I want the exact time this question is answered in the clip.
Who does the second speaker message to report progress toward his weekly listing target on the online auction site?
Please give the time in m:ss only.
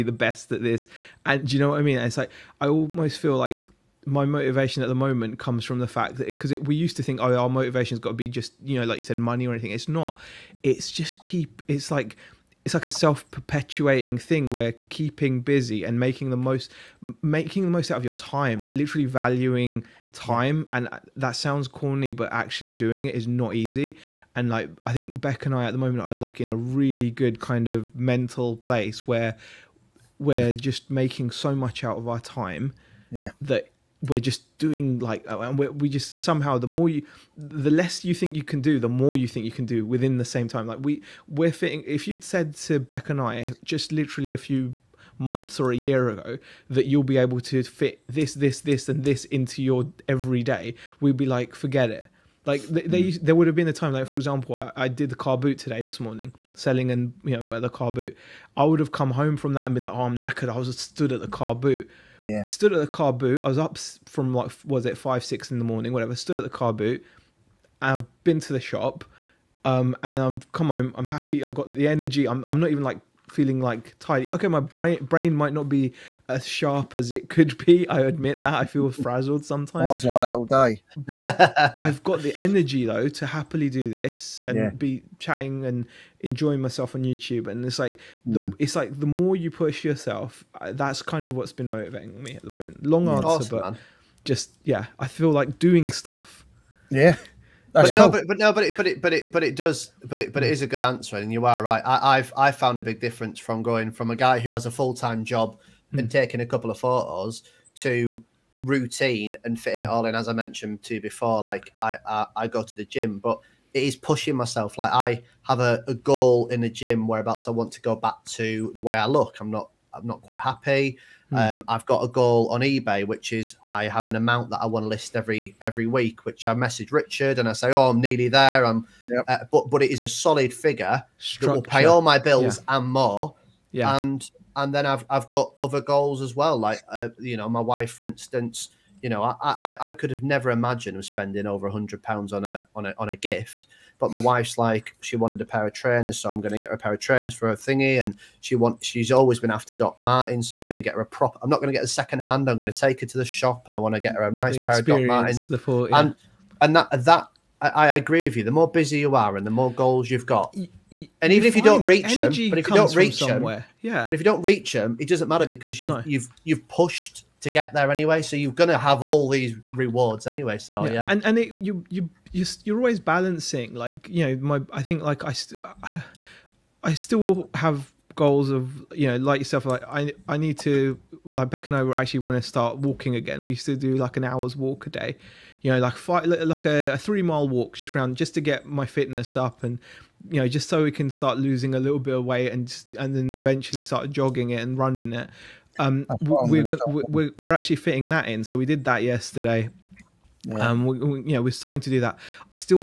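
2:06.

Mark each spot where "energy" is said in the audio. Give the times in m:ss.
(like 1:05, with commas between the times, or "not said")
1:11, 1:22.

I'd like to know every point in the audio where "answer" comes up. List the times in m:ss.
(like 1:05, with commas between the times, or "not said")
1:33, 1:40.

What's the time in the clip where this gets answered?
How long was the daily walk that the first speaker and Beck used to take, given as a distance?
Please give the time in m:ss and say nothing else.
3:06.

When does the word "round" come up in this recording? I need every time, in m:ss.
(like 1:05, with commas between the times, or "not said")
3:07.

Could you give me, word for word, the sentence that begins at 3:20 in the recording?
Um, we, we, you know, we're starting to do that.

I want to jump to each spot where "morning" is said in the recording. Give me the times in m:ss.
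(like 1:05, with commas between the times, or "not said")
0:56, 1:05.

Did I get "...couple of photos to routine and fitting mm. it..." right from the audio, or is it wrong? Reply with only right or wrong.
right.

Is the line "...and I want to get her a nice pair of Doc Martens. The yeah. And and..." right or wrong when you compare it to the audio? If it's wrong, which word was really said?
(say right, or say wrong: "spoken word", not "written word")
right.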